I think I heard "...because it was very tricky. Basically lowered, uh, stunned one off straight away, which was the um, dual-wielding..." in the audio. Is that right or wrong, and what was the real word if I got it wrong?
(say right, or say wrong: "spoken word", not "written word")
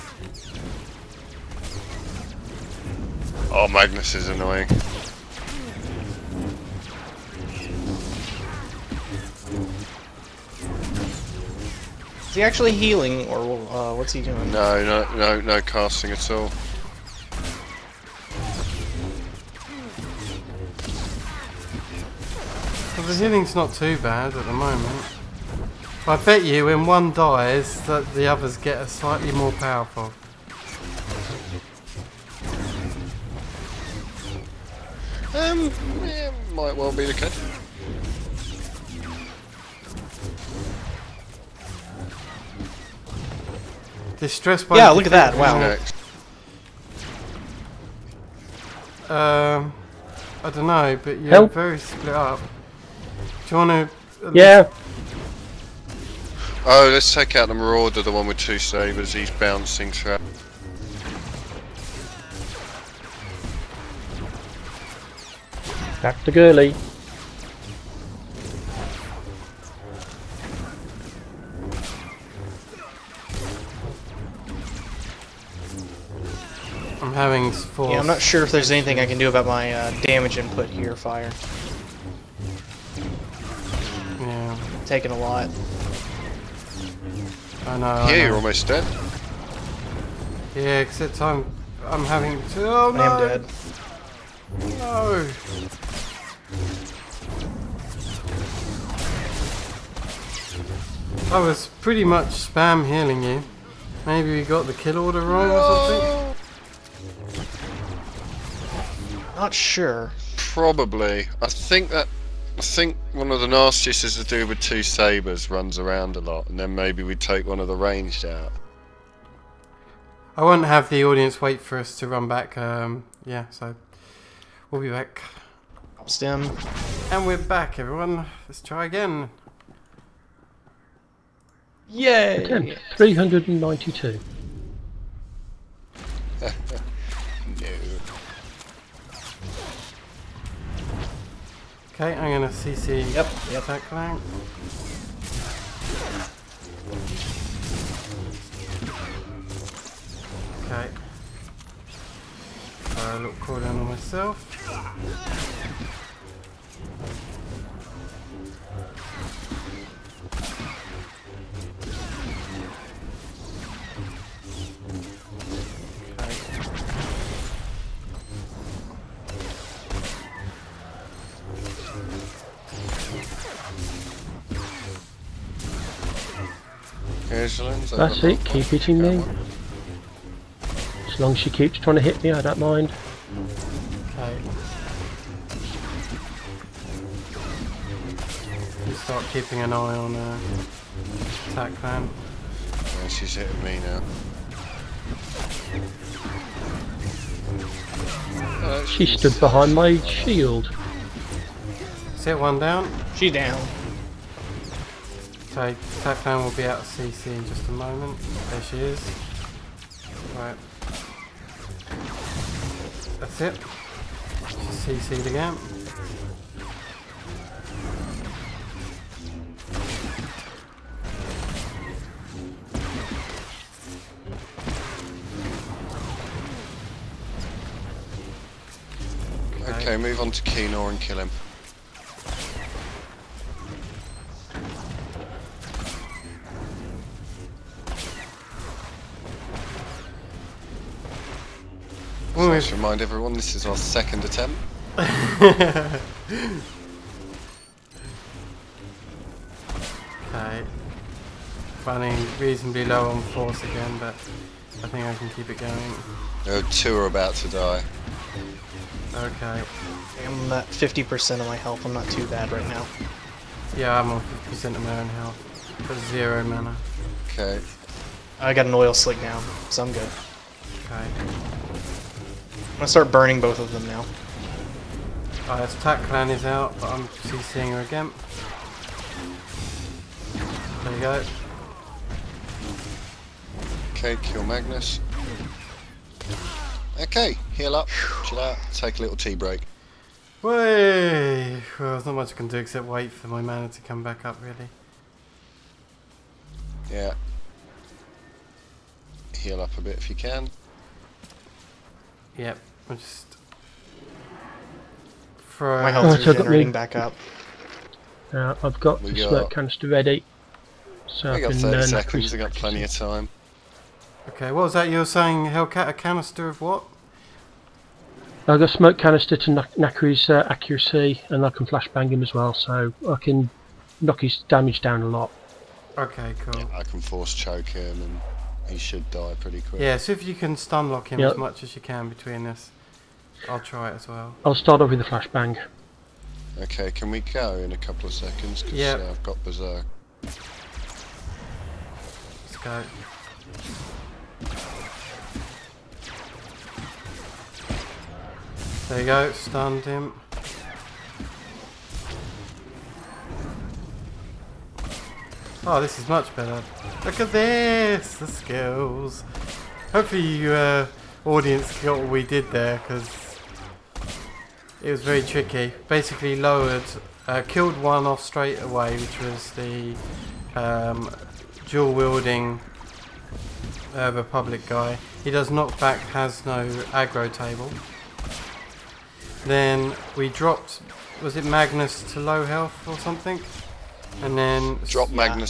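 wrong: "killed", not "stunned".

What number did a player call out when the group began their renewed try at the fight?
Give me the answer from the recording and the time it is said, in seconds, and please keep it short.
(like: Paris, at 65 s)
392, at 132 s.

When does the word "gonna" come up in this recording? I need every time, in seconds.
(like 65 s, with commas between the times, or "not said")
142 s, 272 s.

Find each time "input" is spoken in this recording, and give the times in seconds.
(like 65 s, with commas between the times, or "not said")
80 s.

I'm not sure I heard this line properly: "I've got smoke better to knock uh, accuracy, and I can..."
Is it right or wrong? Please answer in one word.
wrong.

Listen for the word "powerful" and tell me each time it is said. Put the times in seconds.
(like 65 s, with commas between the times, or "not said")
29 s.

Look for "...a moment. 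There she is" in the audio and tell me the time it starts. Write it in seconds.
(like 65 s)
207 s.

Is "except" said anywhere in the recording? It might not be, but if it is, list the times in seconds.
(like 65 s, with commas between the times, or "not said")
90 s, 292 s.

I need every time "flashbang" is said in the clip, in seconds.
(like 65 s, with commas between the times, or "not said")
321 s, 335 s.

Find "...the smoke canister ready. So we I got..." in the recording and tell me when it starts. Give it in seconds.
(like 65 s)
309 s.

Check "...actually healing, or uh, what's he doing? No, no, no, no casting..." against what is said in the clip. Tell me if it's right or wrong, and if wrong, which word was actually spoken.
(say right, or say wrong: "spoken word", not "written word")
right.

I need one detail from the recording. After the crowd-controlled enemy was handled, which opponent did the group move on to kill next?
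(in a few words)
Keenor.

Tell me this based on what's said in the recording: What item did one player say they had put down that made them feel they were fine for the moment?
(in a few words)
An oil slick.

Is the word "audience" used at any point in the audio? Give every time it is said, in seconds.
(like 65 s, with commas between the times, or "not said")
121 s, 361 s.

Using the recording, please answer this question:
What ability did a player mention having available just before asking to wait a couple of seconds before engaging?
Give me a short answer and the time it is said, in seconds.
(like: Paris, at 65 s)
Berserk, at 339 s.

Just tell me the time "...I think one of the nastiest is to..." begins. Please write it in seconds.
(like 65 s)
112 s.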